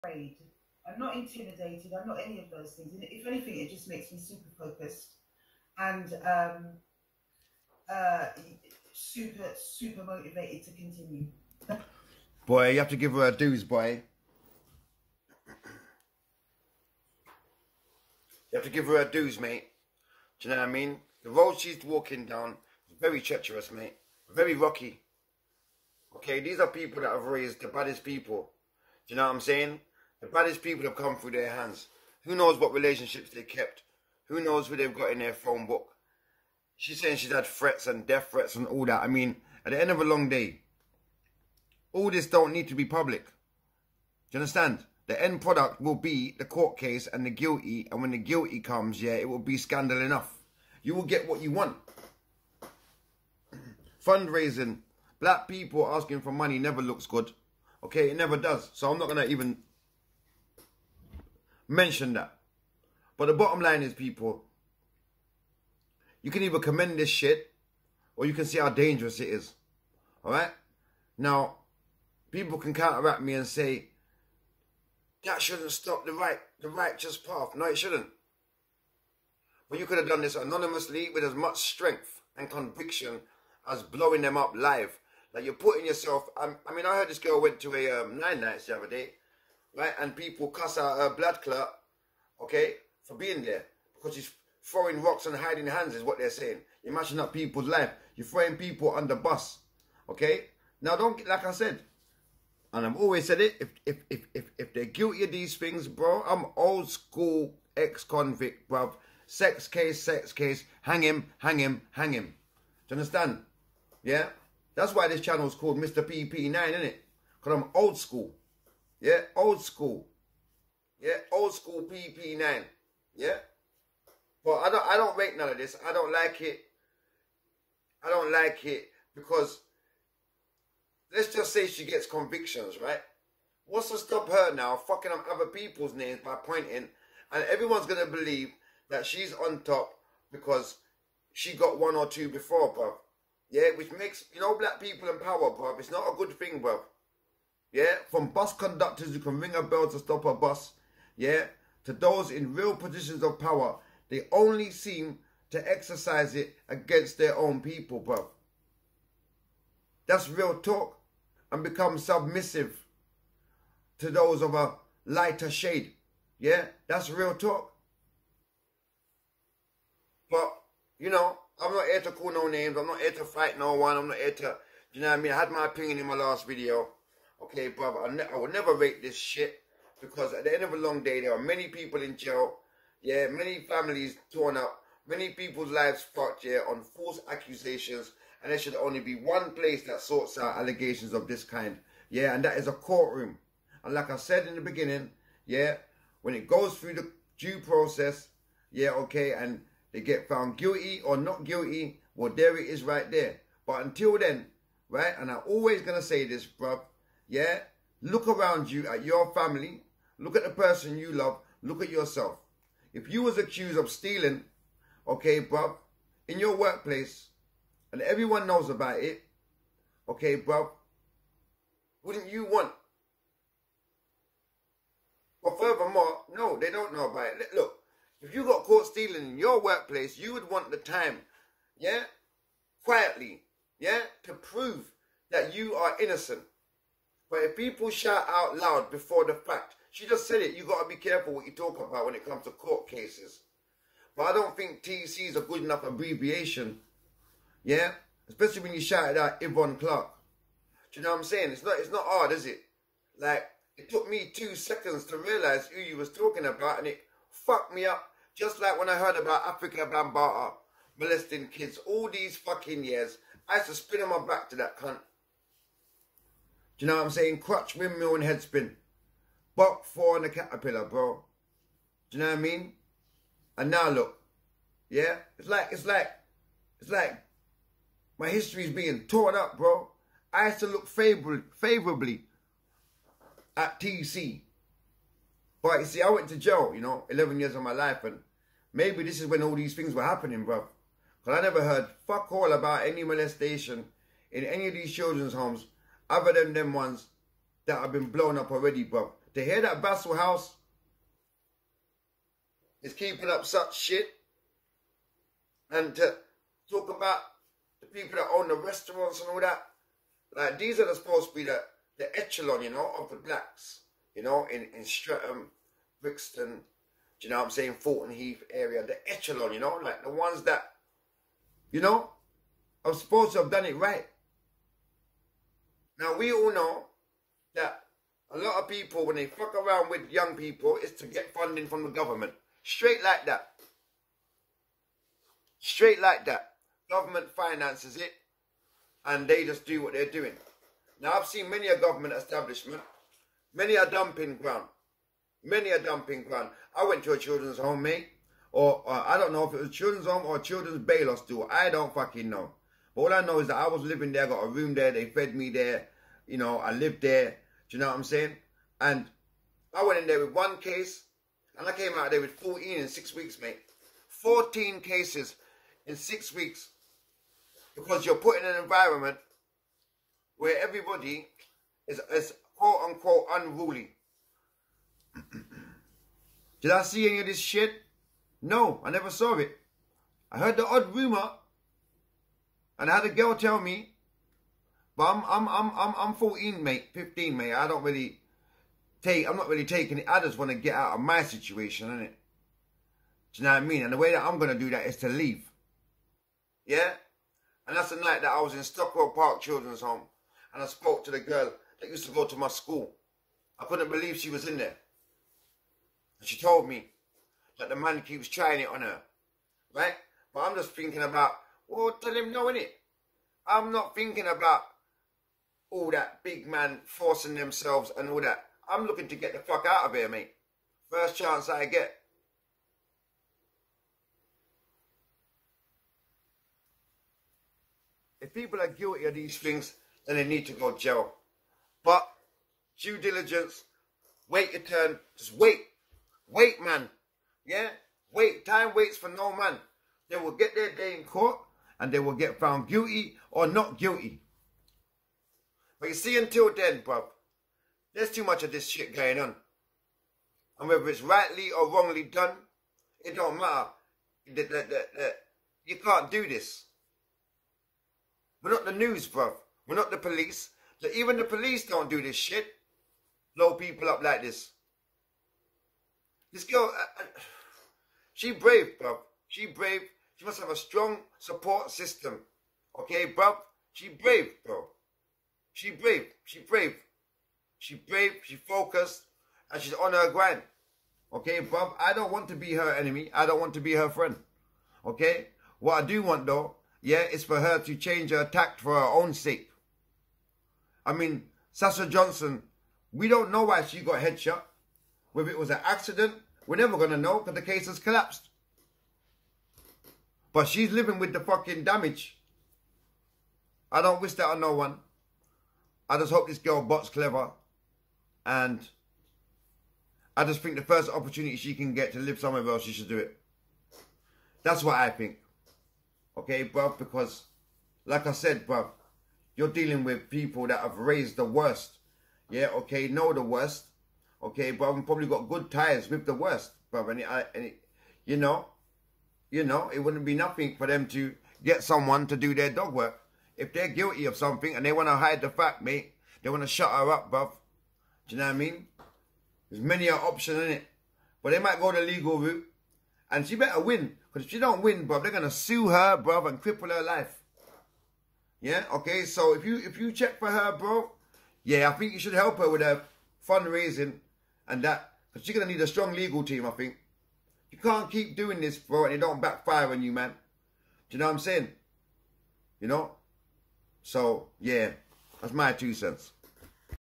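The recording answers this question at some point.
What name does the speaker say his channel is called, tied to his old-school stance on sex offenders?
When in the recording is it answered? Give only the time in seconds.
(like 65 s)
115 s.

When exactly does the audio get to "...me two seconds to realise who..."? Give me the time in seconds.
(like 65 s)
254 s.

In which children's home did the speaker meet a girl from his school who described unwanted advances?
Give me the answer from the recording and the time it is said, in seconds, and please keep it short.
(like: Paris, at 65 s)
Stockwell Park Children's Home, at 398 s.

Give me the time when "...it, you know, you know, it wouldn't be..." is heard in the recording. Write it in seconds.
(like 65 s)
527 s.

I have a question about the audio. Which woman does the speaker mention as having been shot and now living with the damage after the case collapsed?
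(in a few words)
Sasha Johnson.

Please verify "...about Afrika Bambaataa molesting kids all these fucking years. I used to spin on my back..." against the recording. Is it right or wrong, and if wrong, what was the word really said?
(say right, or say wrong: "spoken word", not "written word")
right.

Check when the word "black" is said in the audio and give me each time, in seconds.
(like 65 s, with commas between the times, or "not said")
55 s, 144 s, 313 s.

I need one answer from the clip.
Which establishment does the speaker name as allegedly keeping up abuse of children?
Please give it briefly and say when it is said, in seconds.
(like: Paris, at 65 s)
Vassal House, at 299 s.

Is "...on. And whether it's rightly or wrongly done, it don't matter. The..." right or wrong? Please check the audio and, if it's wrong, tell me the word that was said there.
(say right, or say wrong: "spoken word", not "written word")
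right.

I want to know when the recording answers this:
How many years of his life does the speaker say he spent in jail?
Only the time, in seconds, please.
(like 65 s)
287 s.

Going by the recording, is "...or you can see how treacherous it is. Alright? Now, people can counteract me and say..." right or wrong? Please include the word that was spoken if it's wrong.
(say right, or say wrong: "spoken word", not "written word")
wrong: "dangerous", not "treacherous".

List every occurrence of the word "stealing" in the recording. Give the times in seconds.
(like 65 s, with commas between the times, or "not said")
213 s, 228 s.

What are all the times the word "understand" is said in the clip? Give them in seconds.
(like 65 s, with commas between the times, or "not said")
44 s, 112 s.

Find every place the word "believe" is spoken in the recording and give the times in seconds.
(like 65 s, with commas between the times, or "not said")
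138 s, 403 s.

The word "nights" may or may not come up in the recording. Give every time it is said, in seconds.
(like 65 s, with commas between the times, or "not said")
88 s, 397 s.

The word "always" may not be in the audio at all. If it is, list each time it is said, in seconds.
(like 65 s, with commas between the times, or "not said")
102 s, 205 s.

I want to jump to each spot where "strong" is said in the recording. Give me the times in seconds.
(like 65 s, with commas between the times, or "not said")
470 s, 555 s.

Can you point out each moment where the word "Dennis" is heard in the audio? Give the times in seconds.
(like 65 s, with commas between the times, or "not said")
not said.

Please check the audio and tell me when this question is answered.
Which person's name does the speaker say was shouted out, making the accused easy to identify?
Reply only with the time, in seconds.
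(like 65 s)
249 s.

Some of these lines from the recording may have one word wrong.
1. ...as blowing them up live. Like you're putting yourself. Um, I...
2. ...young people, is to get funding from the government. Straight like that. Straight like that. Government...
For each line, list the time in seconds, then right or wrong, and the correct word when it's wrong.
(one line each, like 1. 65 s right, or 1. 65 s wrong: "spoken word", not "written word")
1. 83 s right
2. 330 s right.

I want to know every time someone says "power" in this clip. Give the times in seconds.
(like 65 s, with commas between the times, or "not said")
145 s, 153 s.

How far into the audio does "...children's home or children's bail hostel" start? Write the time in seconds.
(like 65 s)
349 s.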